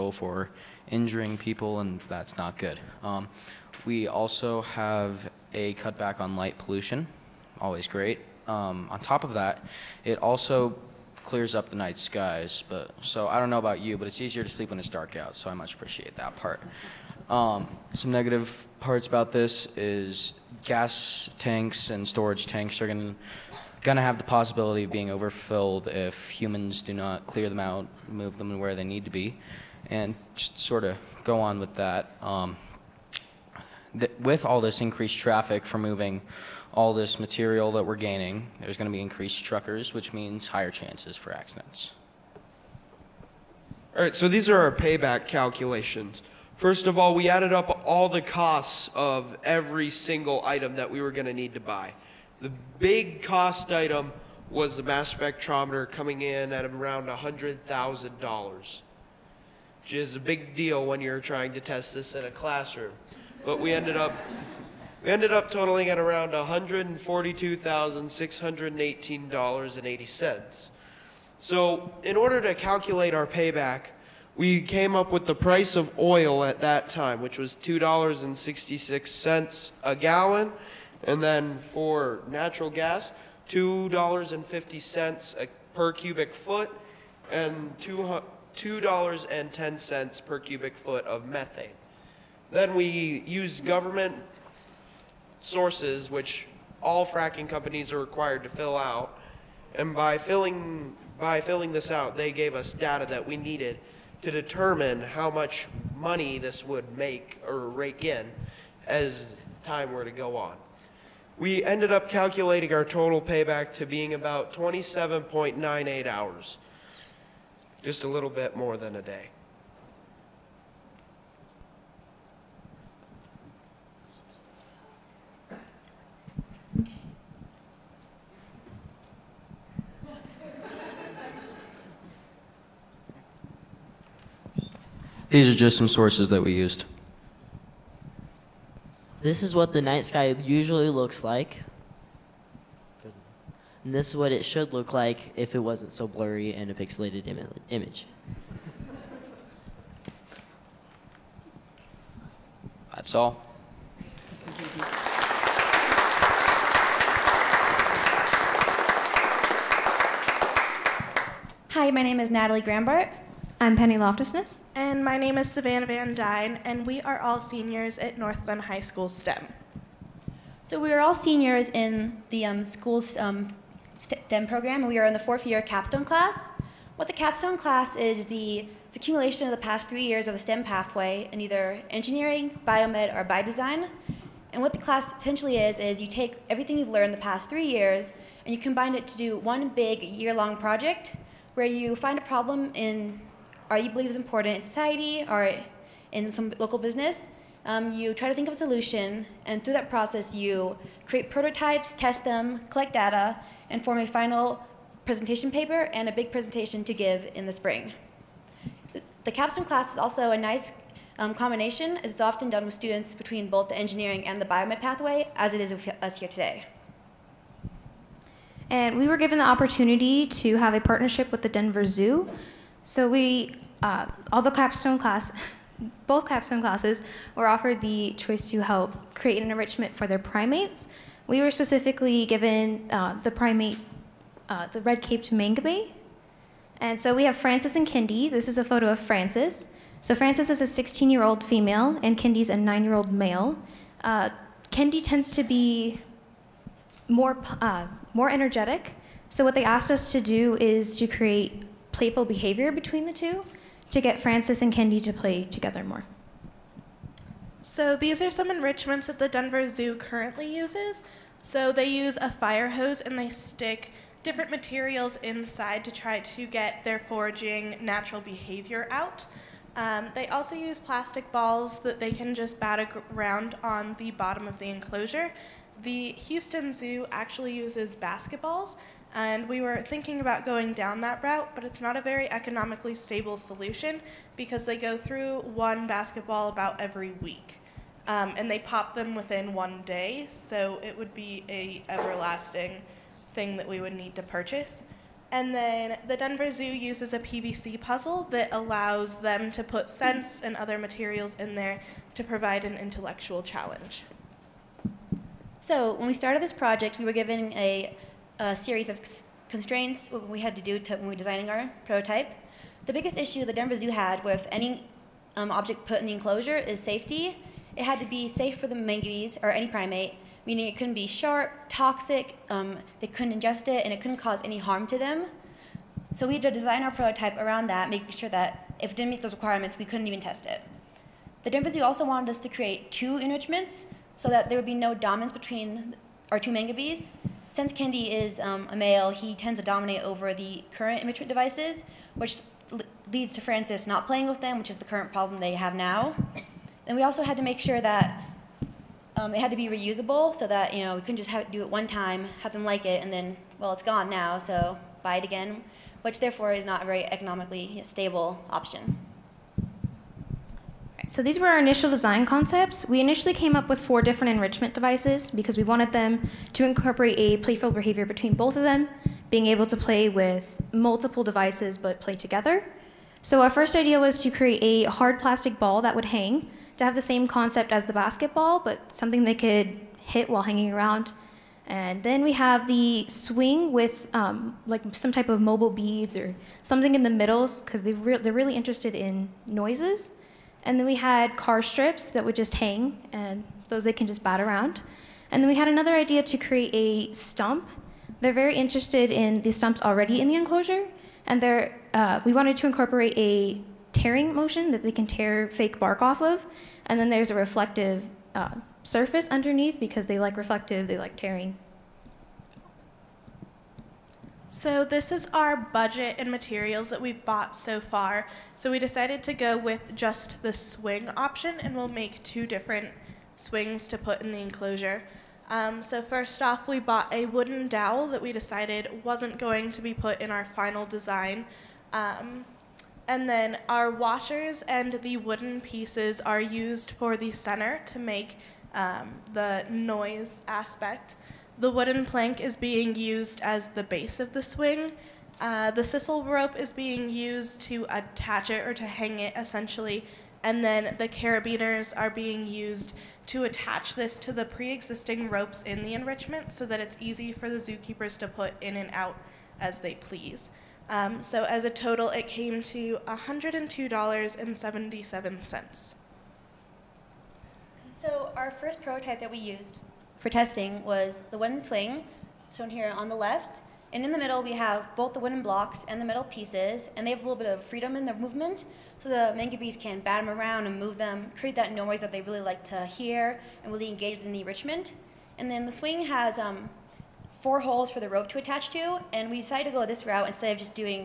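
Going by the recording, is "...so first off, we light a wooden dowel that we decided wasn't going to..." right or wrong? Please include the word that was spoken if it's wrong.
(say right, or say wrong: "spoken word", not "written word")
wrong: "bought", not "light".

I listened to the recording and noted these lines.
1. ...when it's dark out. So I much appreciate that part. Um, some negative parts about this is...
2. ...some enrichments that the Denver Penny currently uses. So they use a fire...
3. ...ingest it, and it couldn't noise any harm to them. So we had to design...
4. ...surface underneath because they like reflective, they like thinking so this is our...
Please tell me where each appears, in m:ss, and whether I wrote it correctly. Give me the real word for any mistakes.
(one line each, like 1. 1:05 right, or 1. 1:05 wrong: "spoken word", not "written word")
1. 0:14 right
2. 4:18 wrong: "Zoo", not "Penny"
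3. 5:23 wrong: "cause", not "noise"
4. 6:48 wrong: "tearing", not "thinking".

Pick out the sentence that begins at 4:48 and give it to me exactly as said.
Um, and they pop them within one day, so it would be a everlasting thing that we would need to purchase.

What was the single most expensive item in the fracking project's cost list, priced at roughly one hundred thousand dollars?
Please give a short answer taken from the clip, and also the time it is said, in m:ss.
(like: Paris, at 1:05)
mass spectrometer, at 0:54.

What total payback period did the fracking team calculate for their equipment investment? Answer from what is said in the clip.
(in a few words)
27.98 hours.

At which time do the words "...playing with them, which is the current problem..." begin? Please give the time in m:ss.
5:44.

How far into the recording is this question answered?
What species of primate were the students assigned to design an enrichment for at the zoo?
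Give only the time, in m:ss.
3:54.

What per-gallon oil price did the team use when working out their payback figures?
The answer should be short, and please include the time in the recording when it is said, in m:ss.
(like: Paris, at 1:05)
$2.66, at 1:17.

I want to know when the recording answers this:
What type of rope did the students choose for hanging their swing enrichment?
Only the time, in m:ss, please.
7:25.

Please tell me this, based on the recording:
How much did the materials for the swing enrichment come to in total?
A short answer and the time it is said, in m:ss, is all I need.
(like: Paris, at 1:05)
$102.77, at 7:43.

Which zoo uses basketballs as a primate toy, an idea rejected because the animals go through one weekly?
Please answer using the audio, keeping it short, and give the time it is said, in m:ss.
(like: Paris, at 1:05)
Houston Zoo, at 4:35.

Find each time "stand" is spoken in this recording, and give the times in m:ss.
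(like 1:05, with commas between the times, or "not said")
not said.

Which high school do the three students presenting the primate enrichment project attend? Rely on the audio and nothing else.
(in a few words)
Northglenn High School.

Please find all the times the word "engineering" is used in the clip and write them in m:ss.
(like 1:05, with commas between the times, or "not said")
3:01, 3:33.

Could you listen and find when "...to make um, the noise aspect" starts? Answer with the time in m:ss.
7:17.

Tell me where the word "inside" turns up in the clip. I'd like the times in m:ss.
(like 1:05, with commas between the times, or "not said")
4:25.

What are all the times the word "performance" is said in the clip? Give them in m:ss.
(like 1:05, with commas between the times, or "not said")
not said.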